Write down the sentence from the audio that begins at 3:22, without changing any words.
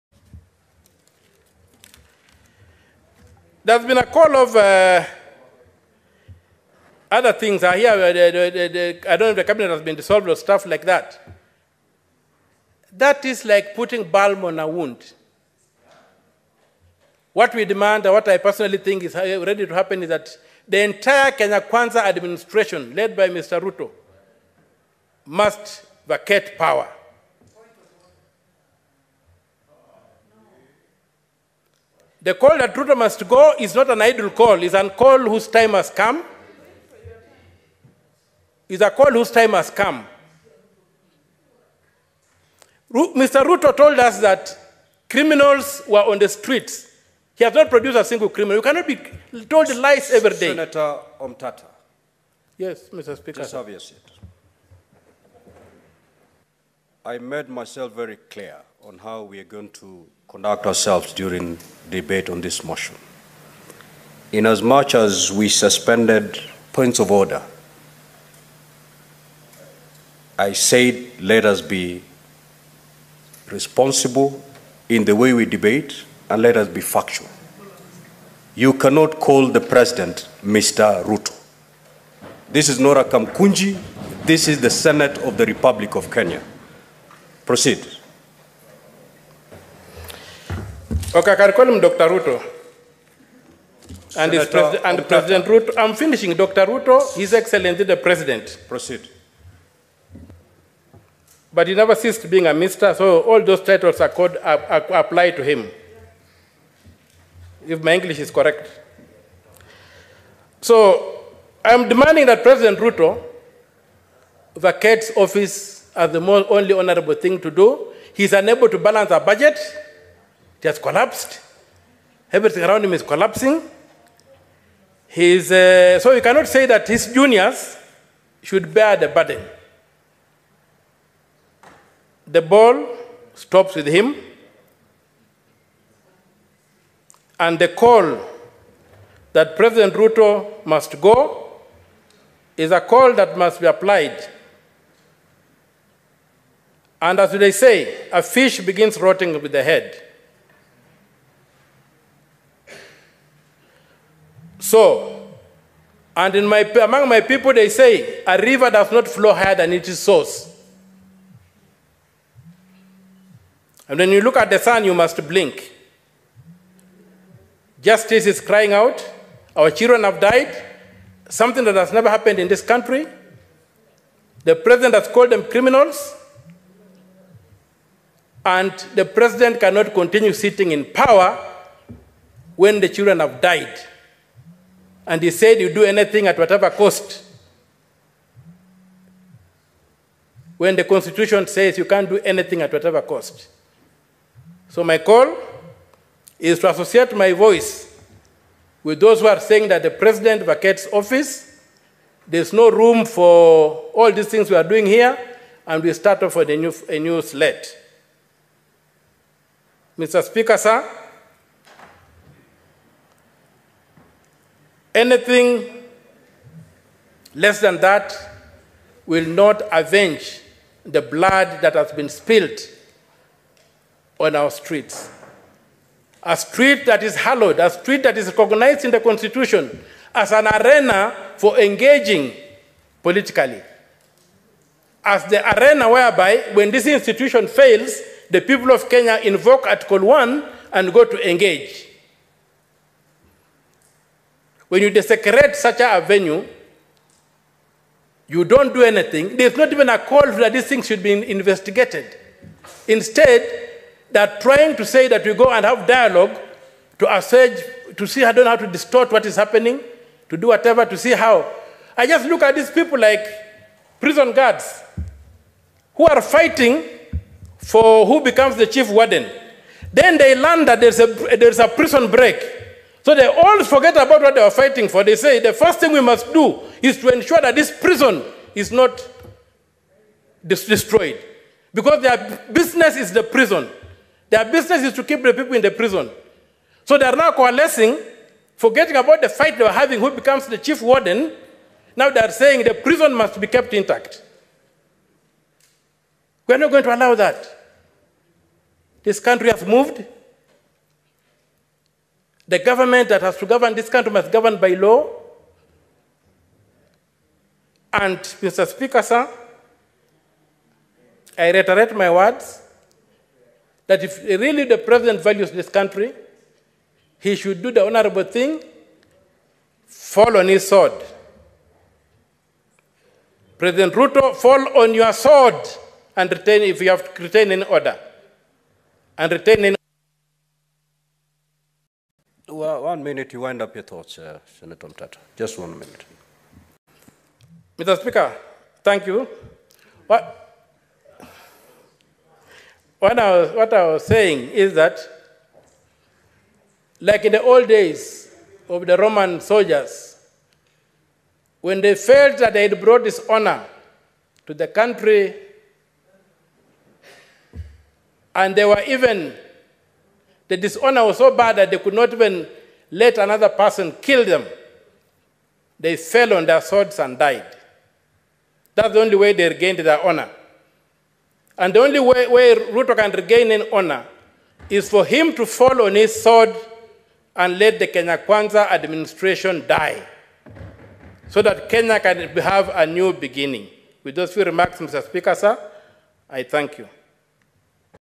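There's no room for all these things we are doing here, and we start off with a new, a new slate.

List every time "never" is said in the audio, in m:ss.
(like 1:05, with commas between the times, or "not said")
1:41, 2:51.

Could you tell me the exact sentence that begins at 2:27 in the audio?
And as they say, a fish begins rotting with the head.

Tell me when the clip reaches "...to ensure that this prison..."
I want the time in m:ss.
4:36.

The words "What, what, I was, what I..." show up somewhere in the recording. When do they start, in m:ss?
5:40.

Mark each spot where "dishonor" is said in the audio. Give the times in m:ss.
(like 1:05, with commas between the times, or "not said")
5:53, 6:00.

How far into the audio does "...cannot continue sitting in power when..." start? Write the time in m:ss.
2:59.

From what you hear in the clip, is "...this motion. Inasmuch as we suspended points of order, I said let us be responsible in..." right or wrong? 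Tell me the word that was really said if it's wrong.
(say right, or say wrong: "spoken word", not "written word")
right.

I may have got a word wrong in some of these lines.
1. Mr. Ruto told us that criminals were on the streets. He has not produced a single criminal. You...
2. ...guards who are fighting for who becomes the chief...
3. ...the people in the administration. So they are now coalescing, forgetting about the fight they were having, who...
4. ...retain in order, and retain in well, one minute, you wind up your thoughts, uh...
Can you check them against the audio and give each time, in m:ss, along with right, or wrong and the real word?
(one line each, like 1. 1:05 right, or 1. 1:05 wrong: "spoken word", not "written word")
1. 0:42 right
2. 4:24 right
3. 4:45 wrong: "prison", not "administration"
4. 5:27 right.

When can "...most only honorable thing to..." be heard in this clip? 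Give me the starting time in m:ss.
1:56.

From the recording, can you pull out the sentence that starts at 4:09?
There's not even a call that these things should be investigated.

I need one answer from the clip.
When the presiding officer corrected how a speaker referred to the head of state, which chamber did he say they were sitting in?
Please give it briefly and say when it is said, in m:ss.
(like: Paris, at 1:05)
Senate, at 1:24.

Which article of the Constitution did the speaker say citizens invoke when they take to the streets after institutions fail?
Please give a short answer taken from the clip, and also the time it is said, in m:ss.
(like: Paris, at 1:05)
Article 1, at 3:59.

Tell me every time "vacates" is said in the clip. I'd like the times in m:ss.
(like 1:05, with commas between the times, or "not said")
0:26, 1:54, 3:20.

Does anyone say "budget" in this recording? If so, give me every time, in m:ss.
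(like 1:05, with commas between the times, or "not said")
1:59.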